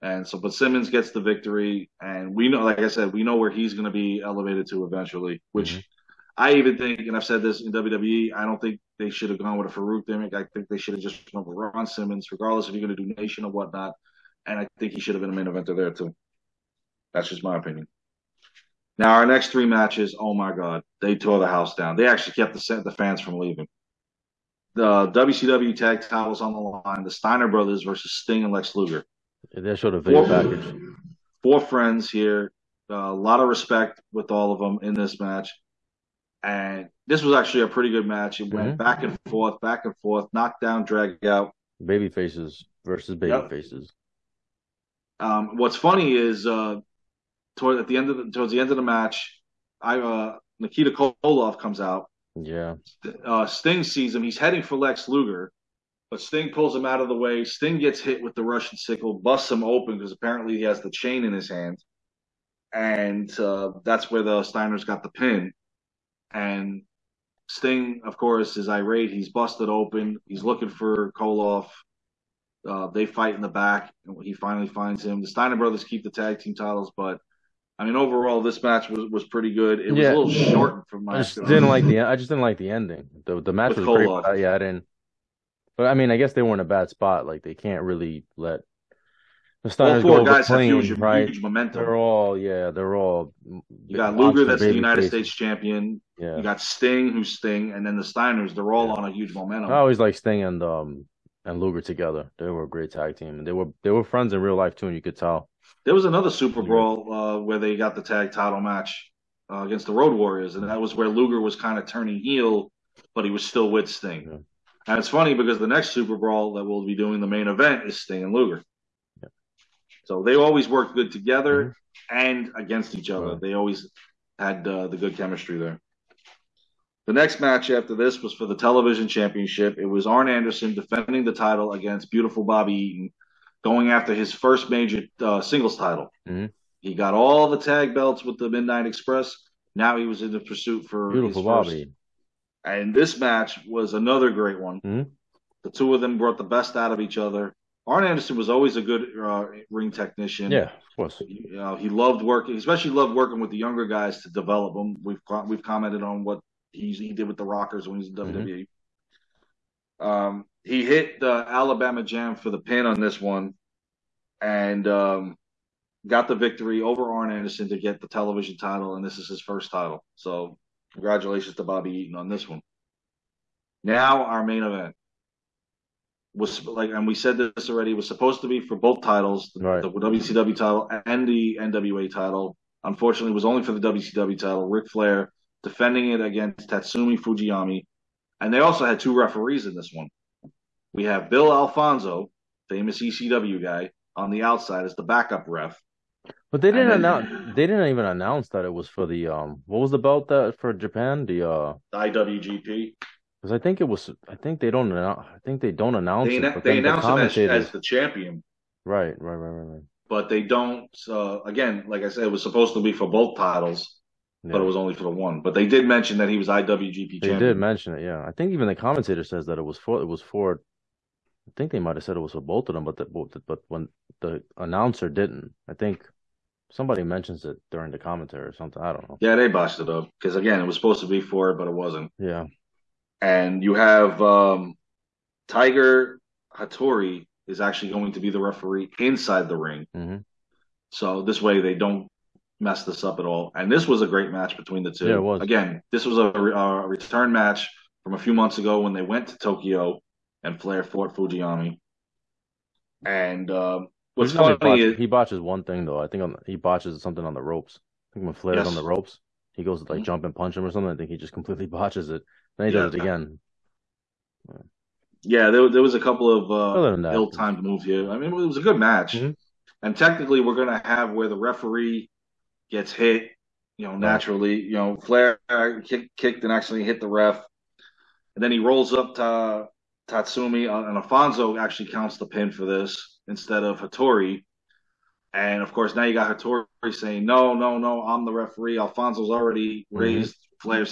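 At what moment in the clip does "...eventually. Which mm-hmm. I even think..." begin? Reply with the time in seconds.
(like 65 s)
4 s.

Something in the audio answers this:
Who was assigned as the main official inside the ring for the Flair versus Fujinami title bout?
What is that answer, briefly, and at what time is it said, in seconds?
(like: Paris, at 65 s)
Tiger Hattori, at 235 s.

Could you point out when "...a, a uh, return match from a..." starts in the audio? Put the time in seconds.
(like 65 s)
246 s.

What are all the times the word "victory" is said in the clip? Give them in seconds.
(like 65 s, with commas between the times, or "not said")
1 s, 166 s.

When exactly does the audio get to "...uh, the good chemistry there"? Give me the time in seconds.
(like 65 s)
124 s.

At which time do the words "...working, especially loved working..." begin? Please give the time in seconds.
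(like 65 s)
152 s.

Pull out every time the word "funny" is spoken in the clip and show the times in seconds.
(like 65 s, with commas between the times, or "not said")
45 s, 115 s, 254 s.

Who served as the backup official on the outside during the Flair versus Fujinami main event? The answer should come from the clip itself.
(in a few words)
Bill Alfonso.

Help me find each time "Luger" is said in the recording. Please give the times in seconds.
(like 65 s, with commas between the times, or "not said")
28 s, 55 s, 94 s, 101 s, 111 s, 118 s.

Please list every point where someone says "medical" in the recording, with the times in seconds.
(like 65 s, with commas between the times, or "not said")
not said.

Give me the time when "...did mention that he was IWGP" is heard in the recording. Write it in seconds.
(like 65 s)
215 s.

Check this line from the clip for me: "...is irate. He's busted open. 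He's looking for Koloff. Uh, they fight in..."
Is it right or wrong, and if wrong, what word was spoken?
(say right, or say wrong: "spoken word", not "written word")
right.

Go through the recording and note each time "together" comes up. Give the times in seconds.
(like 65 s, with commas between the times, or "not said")
101 s, 121 s.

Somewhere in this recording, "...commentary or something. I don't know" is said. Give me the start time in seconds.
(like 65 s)
227 s.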